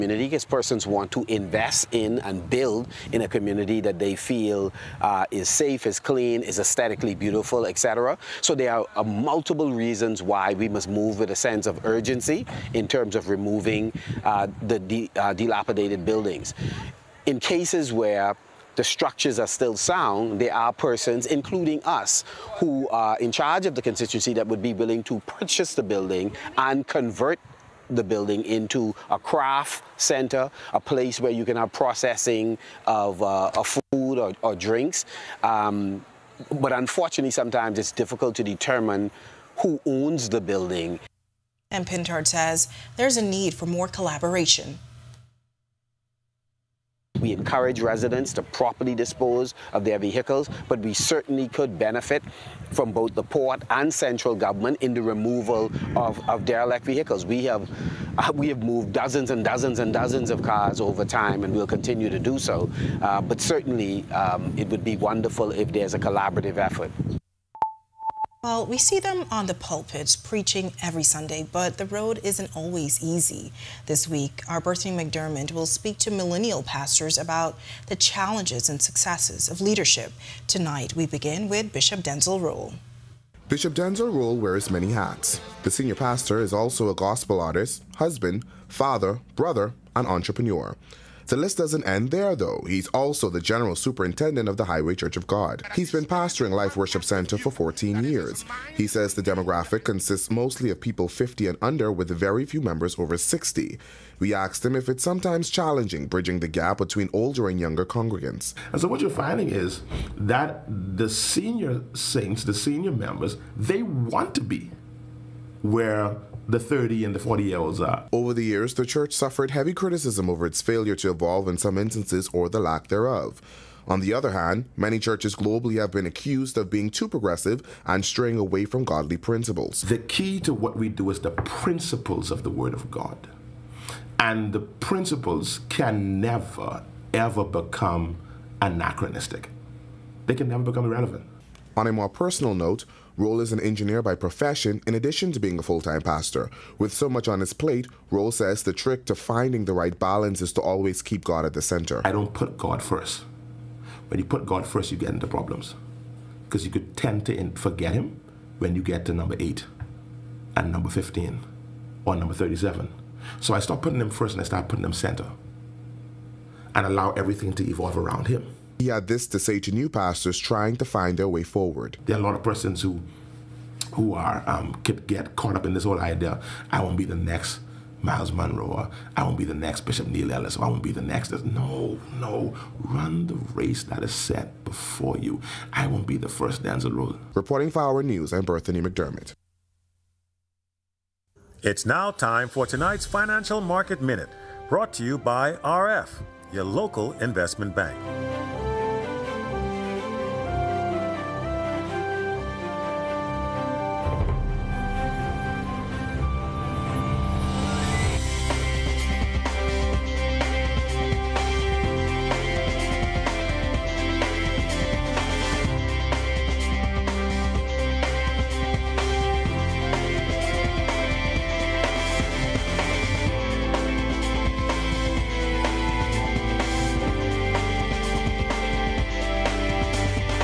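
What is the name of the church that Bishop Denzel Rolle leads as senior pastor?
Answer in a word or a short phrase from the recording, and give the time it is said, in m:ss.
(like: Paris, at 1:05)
Life Worship Center, at 1:36.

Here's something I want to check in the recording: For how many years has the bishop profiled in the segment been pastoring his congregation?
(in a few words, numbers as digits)
14.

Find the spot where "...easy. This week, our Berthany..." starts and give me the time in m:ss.
1:13.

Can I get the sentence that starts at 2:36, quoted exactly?
Because you could tend to forget him when you get to number 8 and number 15 or number 37.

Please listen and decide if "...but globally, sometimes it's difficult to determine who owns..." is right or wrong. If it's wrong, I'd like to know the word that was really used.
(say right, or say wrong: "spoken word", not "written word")
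wrong: "unfortunately", not "globally".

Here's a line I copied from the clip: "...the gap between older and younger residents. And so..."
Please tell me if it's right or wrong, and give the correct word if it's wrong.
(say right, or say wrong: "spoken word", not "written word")
wrong: "congregants", not "residents".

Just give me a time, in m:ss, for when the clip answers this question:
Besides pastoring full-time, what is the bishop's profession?
2:23.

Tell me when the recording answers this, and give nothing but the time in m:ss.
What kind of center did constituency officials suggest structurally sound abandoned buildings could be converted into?
0:29.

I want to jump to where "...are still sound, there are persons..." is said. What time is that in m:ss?
0:19.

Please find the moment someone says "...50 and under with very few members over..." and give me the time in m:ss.
1:41.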